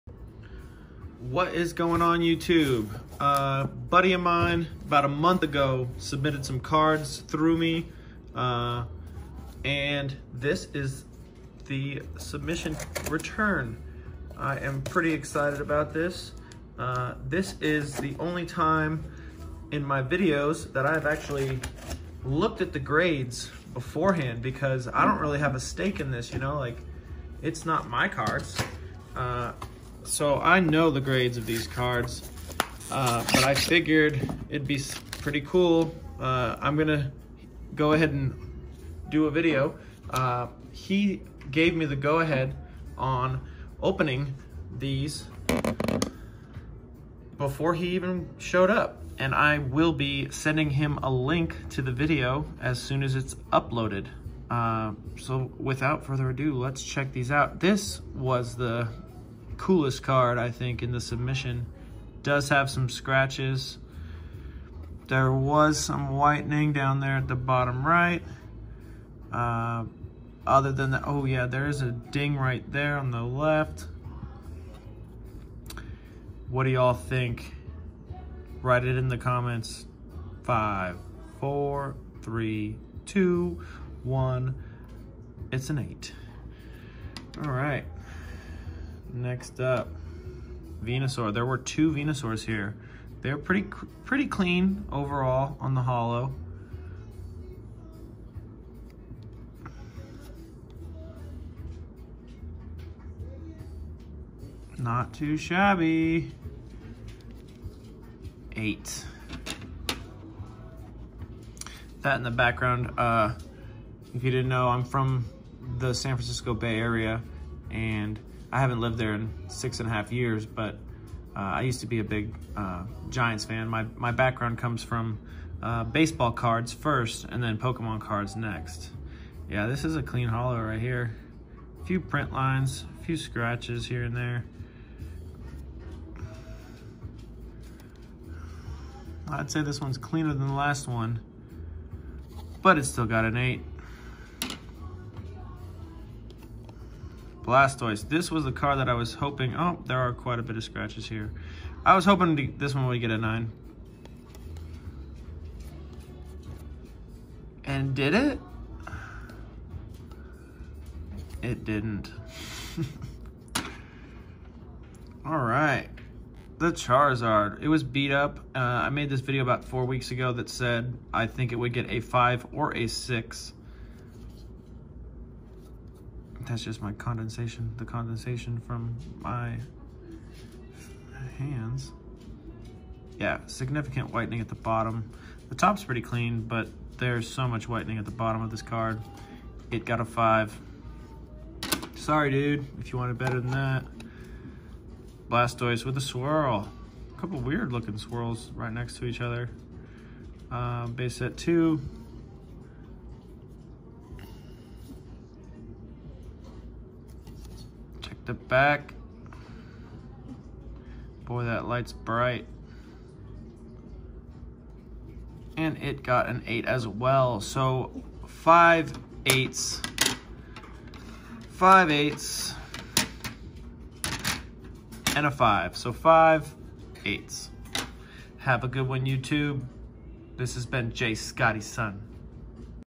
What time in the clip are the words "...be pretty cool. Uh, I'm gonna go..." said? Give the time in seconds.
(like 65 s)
34 s.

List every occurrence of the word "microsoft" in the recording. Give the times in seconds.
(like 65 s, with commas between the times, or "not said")
not said.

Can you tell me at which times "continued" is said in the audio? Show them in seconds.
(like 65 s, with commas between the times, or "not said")
not said.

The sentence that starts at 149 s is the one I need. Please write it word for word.
Oh, there are quite a bit of scratches here.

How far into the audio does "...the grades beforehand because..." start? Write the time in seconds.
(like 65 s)
22 s.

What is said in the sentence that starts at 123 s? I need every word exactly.
My, my background comes from uh, baseball cards first and then Pokemon cards next.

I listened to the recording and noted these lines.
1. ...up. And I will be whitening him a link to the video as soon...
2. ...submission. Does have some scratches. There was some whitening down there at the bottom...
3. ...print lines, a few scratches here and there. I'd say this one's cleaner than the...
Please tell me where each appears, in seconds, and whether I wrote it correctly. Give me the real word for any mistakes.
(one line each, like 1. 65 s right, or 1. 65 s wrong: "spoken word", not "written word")
1. 48 s wrong: "sending", not "whitening"
2. 60 s right
3. 132 s right.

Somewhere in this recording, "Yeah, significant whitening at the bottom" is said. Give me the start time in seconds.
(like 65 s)
183 s.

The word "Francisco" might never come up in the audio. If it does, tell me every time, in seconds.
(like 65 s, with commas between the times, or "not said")
116 s.